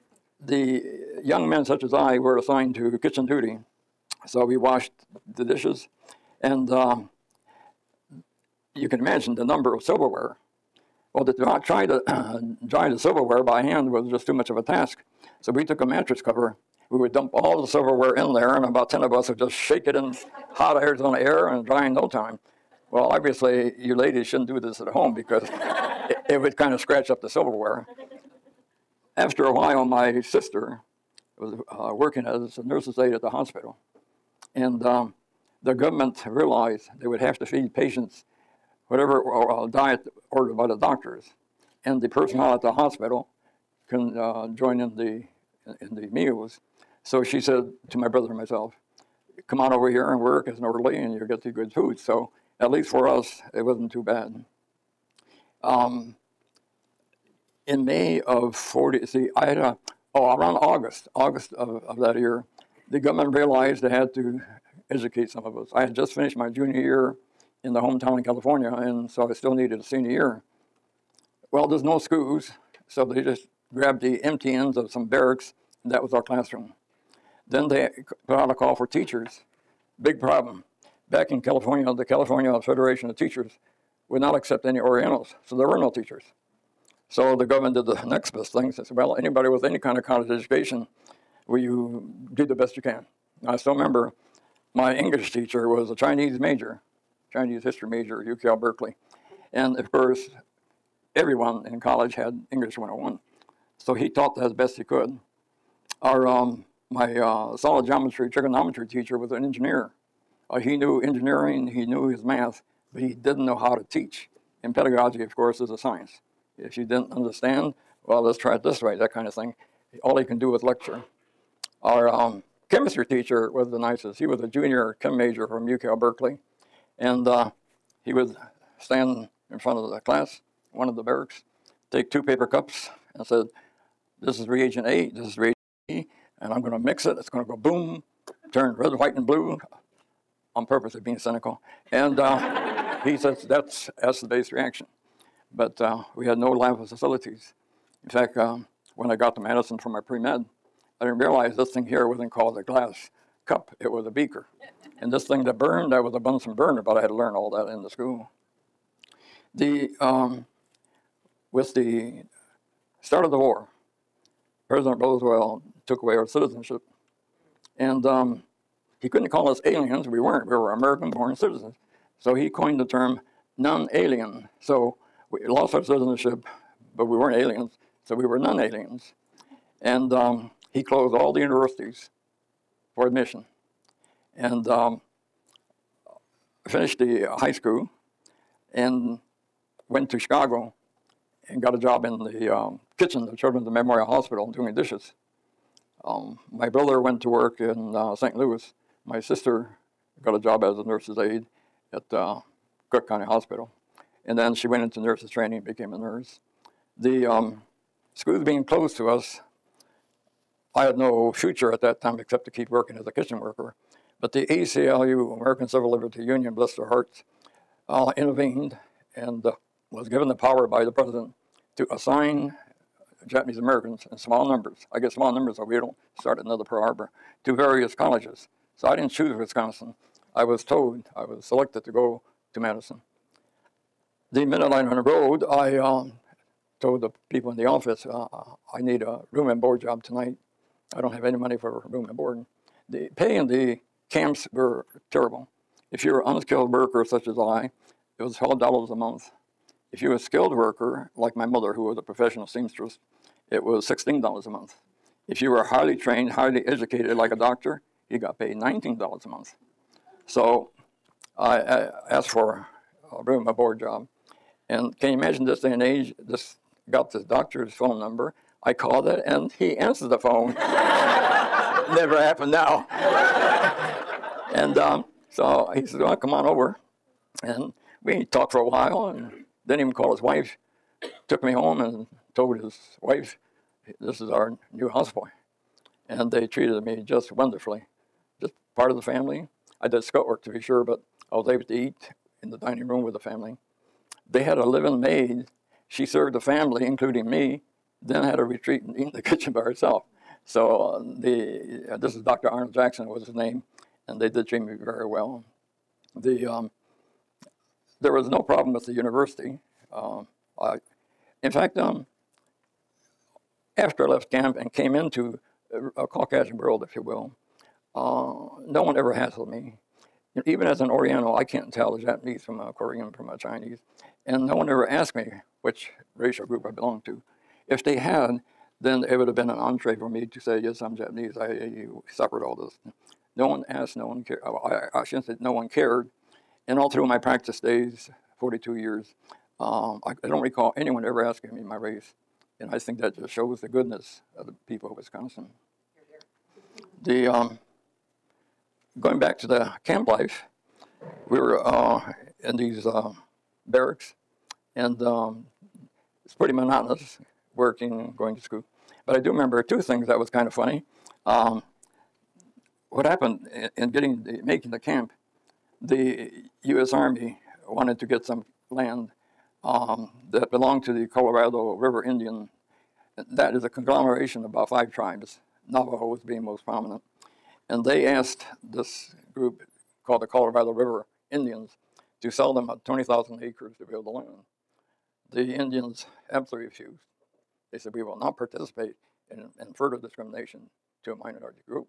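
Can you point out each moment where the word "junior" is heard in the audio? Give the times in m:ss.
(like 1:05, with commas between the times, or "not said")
1:06, 2:04.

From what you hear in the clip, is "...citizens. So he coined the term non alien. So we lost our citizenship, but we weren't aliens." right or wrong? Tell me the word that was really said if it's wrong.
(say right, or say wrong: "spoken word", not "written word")
right.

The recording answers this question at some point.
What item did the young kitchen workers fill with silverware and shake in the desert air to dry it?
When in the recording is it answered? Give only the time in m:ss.
0:15.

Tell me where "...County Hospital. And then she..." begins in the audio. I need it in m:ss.
3:23.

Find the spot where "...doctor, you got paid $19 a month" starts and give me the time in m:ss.
4:17.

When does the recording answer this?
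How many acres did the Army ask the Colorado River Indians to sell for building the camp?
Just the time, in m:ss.
6:22.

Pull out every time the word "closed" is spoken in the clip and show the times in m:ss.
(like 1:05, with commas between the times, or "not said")
3:00, 3:28.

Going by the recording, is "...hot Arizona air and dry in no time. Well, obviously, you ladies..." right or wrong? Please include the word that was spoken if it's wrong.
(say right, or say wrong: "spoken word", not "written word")
right.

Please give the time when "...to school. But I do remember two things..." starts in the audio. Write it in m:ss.
5:58.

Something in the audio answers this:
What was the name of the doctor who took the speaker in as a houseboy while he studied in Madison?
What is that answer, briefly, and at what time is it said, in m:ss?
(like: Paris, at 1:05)
Arnold Jackson, at 5:02.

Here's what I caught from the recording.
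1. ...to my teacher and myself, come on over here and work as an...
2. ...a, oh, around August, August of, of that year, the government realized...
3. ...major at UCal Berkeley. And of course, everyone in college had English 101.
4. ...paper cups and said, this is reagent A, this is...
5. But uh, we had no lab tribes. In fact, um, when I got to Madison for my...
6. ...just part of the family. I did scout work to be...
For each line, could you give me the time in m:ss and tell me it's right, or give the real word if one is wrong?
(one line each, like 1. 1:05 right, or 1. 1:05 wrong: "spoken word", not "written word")
1. 0:47 wrong: "brother", not "teacher"
2. 0:59 right
3. 1:37 right
4. 2:12 right
5. 2:25 wrong: "facilities", not "tribes"
6. 4:48 right.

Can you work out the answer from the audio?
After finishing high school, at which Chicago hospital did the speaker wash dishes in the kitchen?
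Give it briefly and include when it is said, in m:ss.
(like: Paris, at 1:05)
Children's Memorial Hospital, at 3:13.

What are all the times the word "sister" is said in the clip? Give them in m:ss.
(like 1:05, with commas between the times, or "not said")
0:30, 3:19.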